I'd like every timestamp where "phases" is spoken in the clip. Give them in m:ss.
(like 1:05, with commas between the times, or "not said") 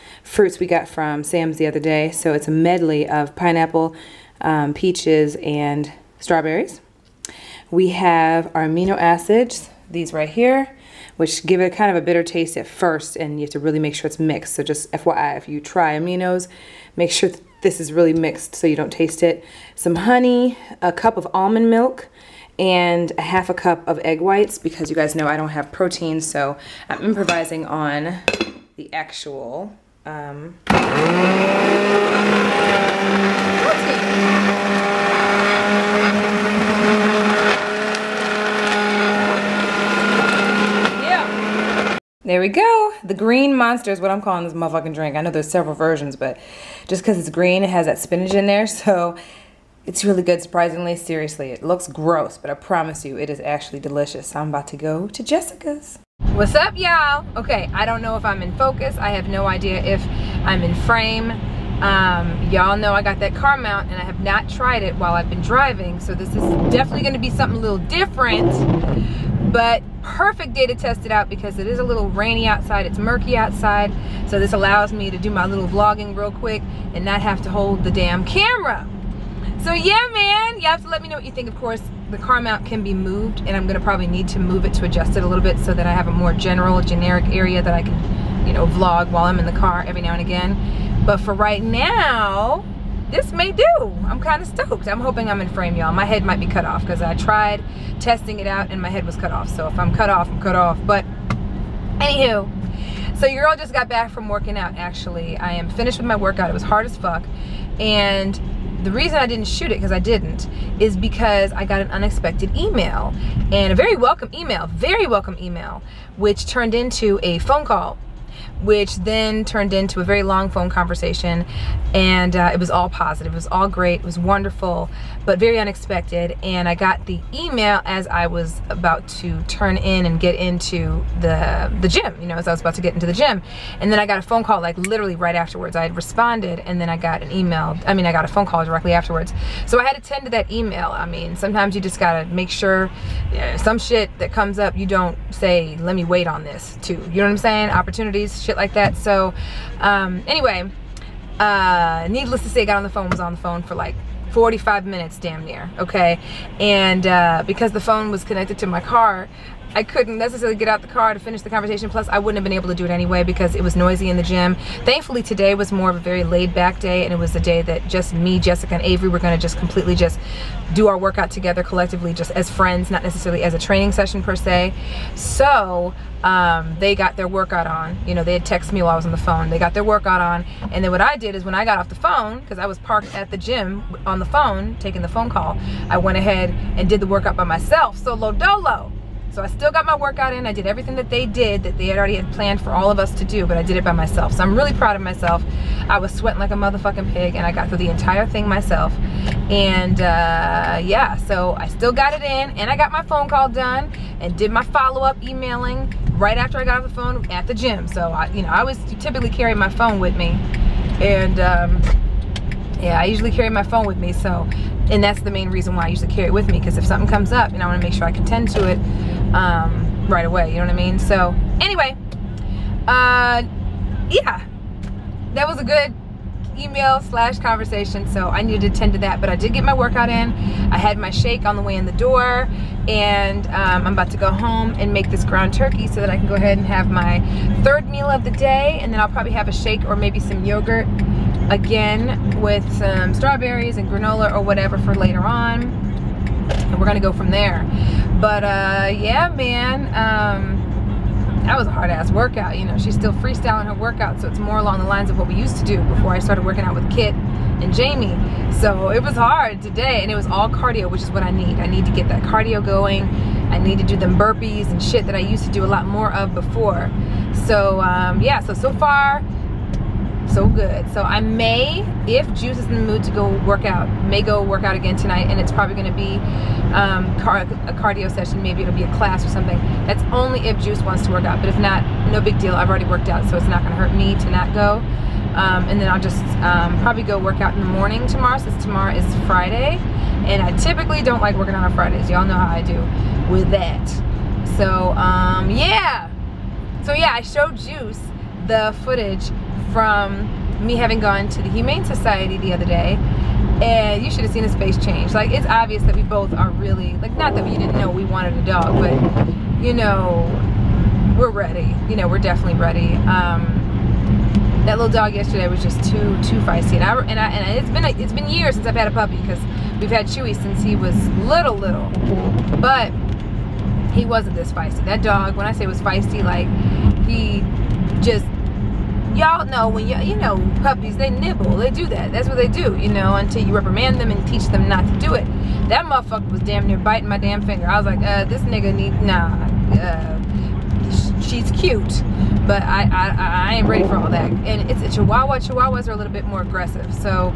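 not said.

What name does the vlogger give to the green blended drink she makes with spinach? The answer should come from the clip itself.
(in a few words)
The green monster.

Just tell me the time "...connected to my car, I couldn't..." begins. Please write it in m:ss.
2:38.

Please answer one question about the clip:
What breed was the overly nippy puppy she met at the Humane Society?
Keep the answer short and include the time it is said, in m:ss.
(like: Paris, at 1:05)
Chihuahua, at 5:44.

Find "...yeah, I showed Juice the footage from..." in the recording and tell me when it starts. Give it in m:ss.
4:56.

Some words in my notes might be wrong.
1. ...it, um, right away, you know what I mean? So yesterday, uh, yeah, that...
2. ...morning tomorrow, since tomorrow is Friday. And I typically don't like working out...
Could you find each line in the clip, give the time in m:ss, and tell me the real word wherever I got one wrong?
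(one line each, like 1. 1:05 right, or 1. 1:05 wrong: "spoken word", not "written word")
1. 3:38 wrong: "anyway", not "yesterday"
2. 4:47 right.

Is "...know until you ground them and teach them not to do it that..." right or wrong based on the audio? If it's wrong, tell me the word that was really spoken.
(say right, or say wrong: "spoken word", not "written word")
wrong: "reprimand", not "ground".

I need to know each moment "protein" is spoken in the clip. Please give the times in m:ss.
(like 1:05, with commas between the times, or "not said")
0:25, 0:30.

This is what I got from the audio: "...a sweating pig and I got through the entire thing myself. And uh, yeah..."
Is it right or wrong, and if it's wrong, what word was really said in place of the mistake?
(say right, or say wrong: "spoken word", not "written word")
wrong: "motherfucking", not "sweating".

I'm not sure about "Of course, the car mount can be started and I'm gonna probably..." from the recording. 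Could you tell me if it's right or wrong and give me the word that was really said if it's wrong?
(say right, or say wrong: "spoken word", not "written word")
wrong: "moved", not "started".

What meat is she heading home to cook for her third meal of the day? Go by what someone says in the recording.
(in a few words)
ground turkey.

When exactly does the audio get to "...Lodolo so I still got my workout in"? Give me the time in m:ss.
3:08.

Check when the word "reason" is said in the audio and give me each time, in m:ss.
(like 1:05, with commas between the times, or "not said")
1:48, 3:35.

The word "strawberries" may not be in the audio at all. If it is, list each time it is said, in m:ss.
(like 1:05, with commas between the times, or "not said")
0:06, 4:03.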